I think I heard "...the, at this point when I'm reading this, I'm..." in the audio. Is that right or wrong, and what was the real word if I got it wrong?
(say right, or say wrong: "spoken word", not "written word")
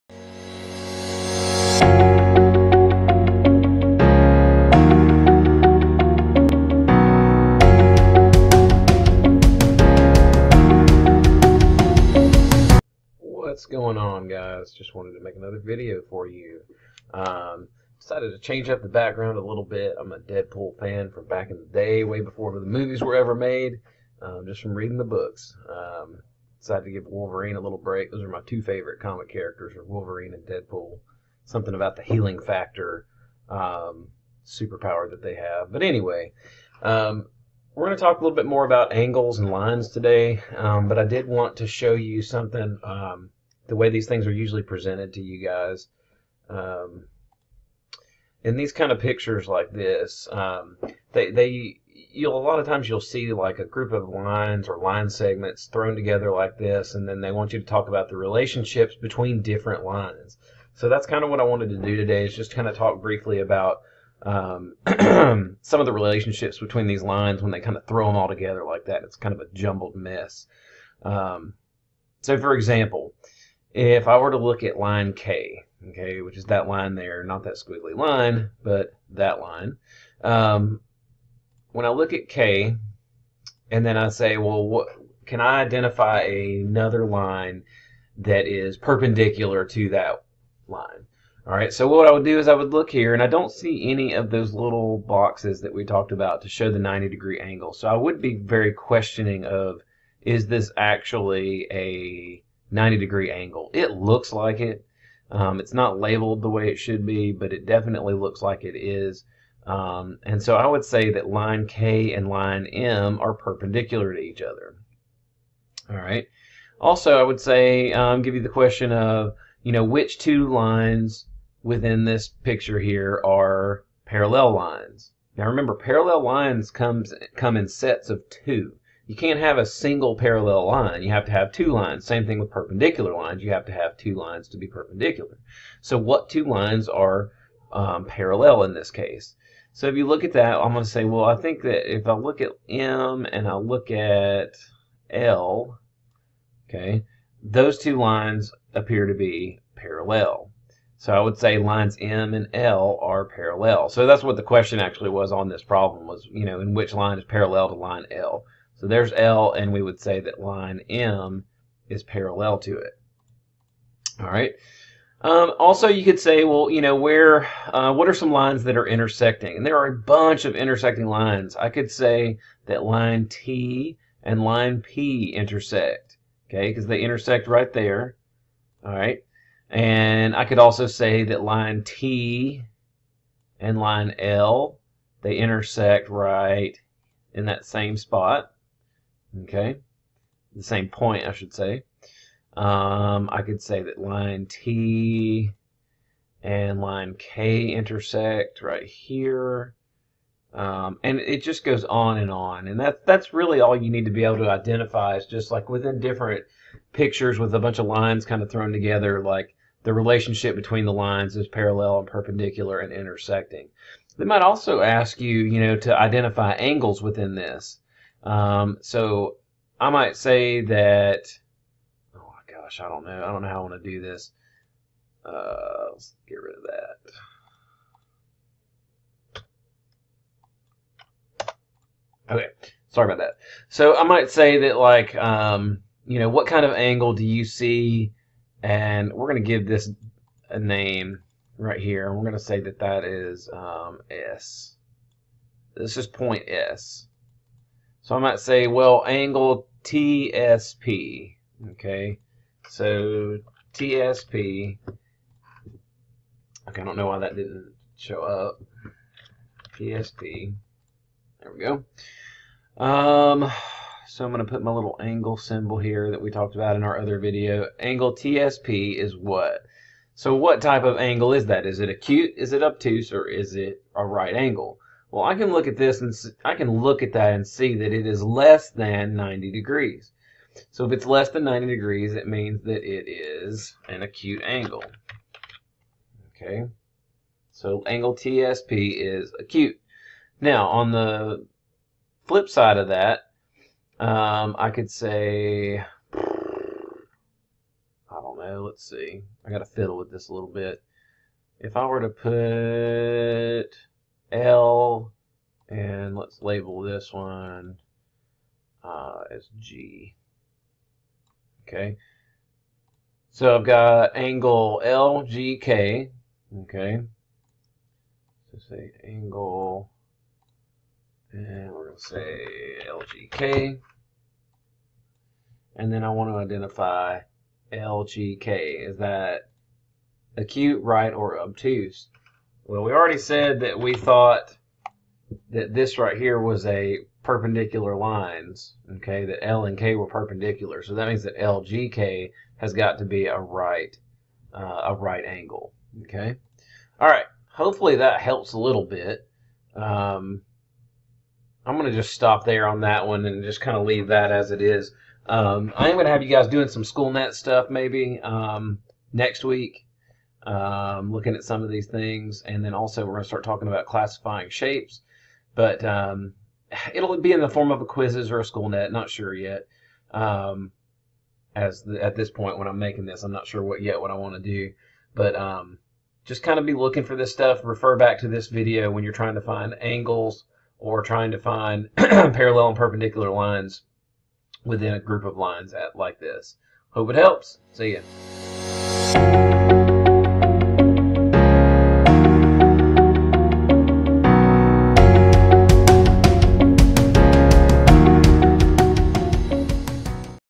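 wrong: "making", not "reading".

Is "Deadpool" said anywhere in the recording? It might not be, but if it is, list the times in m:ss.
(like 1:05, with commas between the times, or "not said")
0:20, 0:30.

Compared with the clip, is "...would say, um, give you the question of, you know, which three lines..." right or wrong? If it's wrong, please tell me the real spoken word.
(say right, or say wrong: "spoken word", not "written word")
wrong: "two", not "three".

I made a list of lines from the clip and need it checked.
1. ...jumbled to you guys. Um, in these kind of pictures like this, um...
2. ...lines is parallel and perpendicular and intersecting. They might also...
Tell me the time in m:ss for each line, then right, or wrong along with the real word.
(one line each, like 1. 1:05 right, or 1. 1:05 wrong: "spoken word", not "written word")
1. 0:44 wrong: "presented", not "jumbled"
2. 3:30 right.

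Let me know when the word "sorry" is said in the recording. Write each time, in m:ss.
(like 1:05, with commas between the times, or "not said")
3:52.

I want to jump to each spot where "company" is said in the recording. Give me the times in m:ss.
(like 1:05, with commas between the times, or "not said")
not said.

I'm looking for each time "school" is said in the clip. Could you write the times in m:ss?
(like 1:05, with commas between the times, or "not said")
5:56, 6:08.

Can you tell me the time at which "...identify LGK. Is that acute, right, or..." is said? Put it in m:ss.
5:26.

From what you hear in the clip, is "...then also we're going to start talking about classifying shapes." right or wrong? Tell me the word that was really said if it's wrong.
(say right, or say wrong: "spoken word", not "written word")
right.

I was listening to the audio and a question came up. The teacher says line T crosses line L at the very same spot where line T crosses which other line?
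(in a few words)
Line P.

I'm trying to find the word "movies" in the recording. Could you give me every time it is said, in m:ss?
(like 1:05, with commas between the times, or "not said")
0:22.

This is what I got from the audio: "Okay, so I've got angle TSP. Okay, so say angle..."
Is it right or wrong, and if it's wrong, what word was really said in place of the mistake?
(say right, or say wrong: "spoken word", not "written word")
wrong: "LGK", not "TSP".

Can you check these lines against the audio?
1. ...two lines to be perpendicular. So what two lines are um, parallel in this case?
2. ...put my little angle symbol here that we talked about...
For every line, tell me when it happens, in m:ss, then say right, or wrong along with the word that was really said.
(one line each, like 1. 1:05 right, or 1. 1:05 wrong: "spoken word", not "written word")
1. 2:13 right
2. 4:24 right.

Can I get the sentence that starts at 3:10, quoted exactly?
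The same point, I should say.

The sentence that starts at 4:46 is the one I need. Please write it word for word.
Okay, so angle TSP is acute.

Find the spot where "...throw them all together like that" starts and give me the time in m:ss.
1:07.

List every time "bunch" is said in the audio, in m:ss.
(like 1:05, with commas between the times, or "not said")
2:49, 3:27.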